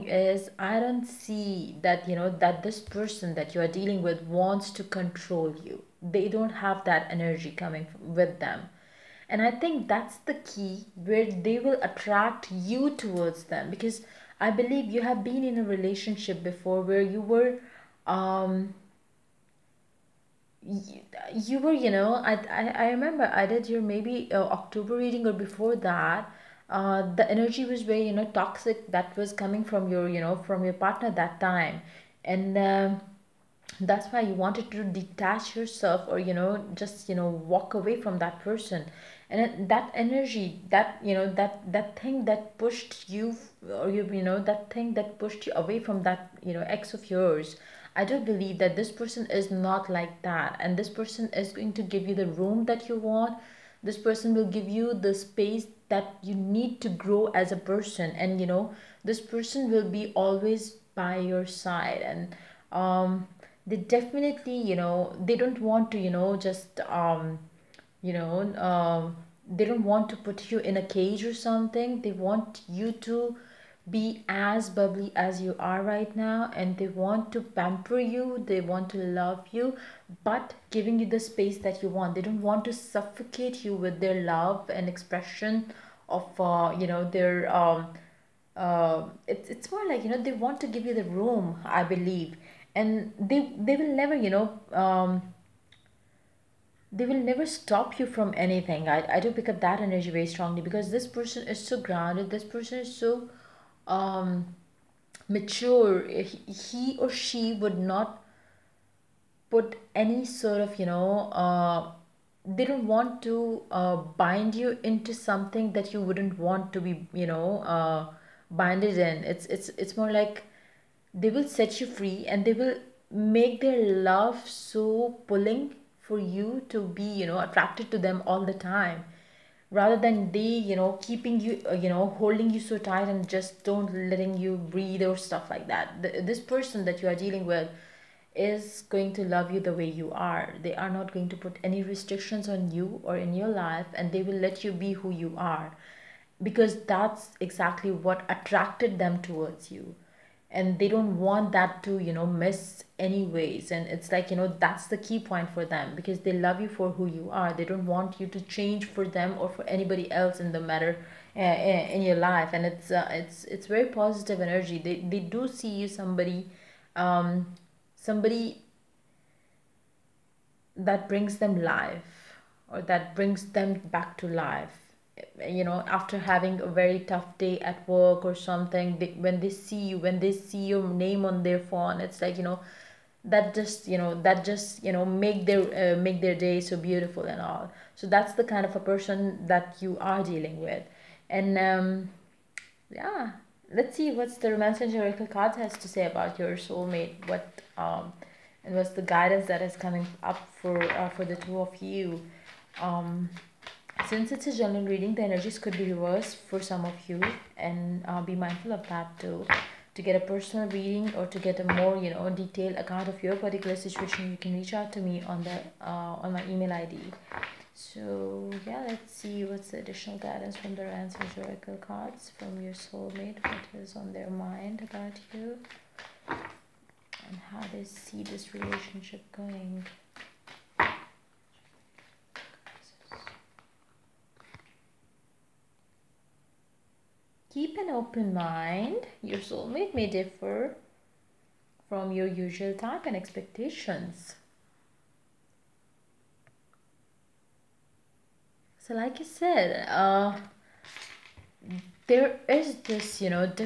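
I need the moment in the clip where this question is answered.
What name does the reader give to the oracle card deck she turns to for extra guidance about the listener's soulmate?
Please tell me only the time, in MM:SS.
03:14.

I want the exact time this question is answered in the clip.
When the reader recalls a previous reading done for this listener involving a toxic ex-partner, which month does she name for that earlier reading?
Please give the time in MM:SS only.
00:24.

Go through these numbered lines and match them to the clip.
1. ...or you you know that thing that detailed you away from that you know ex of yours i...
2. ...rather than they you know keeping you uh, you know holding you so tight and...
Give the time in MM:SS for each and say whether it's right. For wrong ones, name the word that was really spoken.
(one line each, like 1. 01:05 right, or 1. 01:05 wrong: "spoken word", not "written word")
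1. 00:43 wrong: "pushed", not "detailed"
2. 02:09 right.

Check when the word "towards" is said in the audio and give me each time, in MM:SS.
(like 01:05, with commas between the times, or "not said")
00:13, 02:29.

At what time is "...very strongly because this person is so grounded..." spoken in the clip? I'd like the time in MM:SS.
01:40.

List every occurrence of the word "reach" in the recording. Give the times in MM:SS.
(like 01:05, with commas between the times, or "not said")
03:34.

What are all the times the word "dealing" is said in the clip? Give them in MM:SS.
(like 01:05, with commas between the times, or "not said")
00:03, 02:17, 03:10.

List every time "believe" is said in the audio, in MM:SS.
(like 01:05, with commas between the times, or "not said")
00:14, 00:48, 01:31.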